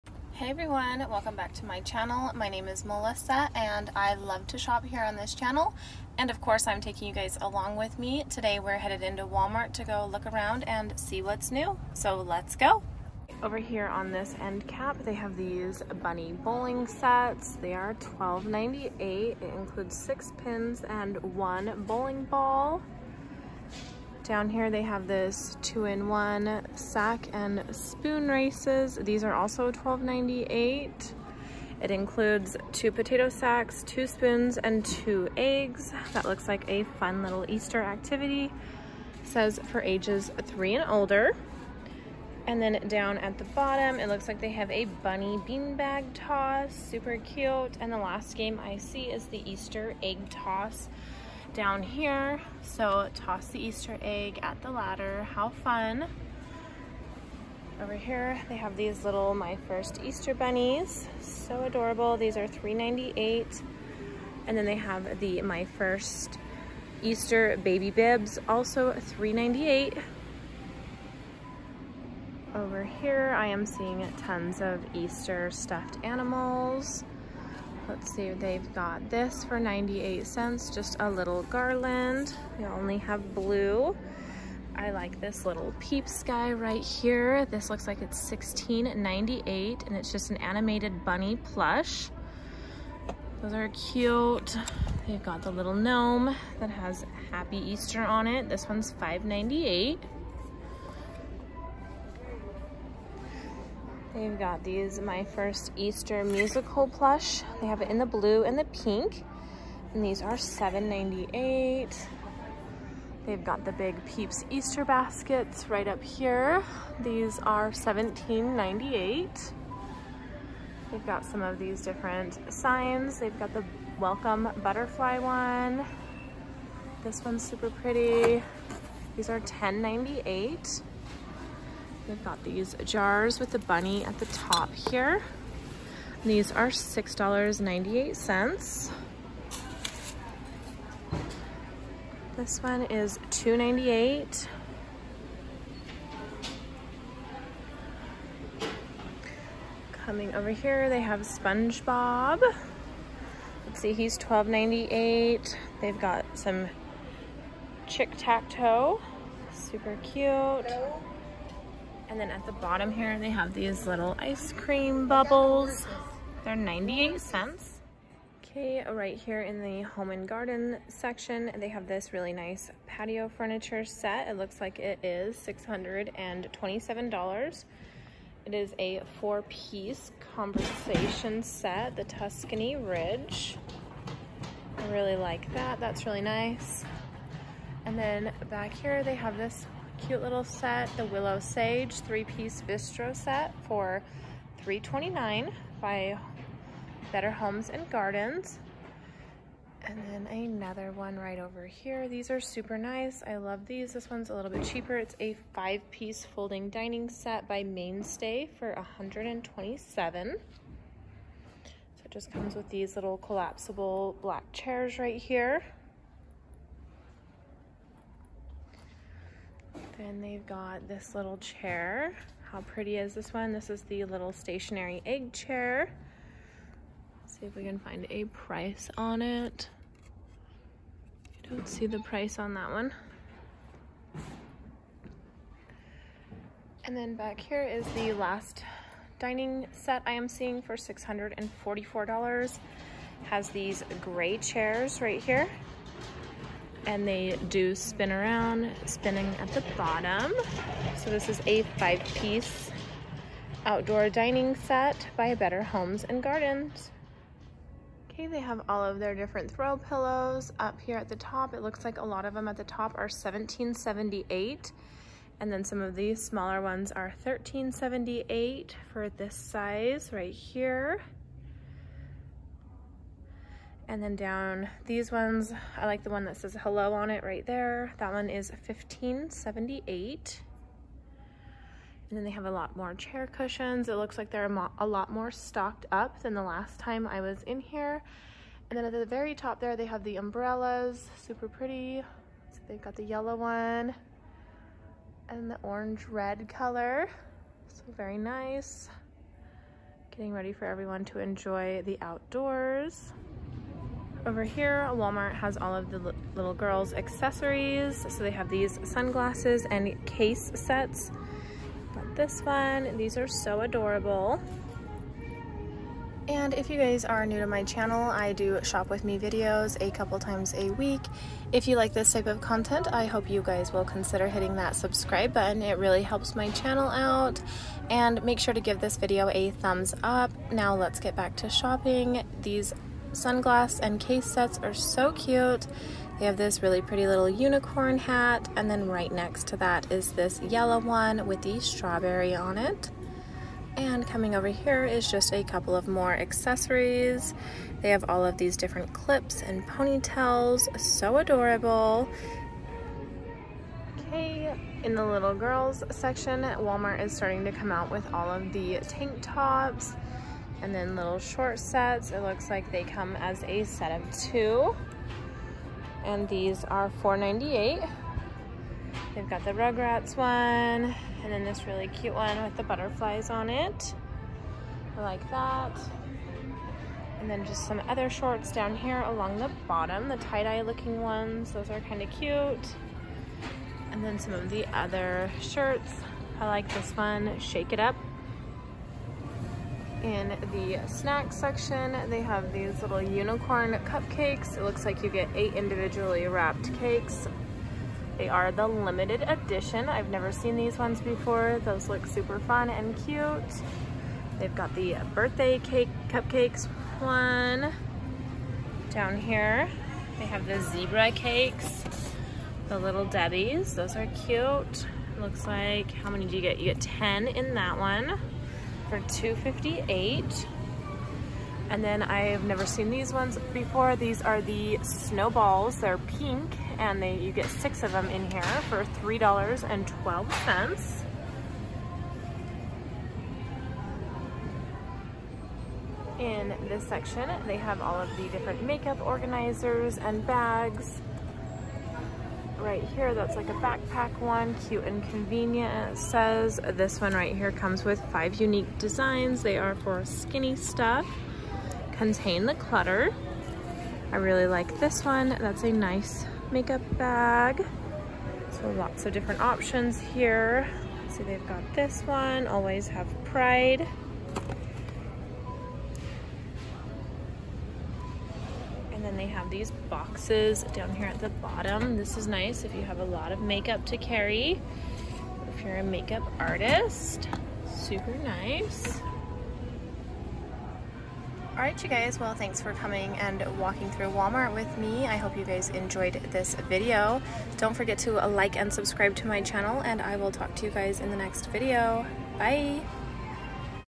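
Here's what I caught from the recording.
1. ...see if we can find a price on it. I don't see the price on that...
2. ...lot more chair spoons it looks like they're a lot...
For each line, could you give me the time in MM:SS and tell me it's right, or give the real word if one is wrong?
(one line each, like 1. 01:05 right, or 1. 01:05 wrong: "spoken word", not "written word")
1. 03:47 right
2. 04:42 wrong: "cushions", not "spoons".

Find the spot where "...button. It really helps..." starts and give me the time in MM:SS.
05:25.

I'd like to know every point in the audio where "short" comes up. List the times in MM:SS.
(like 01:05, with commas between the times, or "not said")
06:01, 06:18.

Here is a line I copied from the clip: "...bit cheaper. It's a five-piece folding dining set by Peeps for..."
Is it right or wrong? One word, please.
wrong.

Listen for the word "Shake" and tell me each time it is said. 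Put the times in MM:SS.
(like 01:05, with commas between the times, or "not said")
06:27.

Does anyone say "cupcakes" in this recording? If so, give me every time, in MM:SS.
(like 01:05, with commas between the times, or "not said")
06:33, 06:46.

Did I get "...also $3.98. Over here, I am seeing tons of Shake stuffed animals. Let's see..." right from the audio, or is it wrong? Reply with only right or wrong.
wrong.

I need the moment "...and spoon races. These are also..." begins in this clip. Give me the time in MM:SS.
00:27.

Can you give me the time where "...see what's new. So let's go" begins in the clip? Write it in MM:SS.
00:10.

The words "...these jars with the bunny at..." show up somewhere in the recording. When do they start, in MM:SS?
02:12.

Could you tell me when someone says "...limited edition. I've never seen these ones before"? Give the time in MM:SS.
06:38.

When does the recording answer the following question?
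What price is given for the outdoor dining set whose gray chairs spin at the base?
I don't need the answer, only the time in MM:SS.
04:00.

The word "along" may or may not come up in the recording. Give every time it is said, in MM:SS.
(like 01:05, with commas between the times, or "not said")
00:07, 06:19.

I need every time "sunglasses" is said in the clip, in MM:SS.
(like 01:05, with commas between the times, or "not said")
05:08, 05:33.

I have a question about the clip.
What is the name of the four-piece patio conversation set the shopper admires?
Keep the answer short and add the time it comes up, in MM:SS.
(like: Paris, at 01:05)
Tuscany Ridge, at 03:01.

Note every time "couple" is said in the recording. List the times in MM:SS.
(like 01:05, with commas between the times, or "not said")
05:19, 05:45.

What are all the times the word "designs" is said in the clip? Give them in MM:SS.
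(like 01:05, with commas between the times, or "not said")
07:28.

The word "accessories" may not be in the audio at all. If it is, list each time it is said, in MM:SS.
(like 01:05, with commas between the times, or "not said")
05:06, 05:46.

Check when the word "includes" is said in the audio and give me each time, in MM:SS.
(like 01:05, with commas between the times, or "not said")
00:19, 00:31.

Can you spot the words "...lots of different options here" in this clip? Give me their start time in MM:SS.
07:38.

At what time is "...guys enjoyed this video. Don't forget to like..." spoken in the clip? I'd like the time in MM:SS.
08:05.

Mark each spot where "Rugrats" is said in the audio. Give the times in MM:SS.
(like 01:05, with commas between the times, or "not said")
06:09.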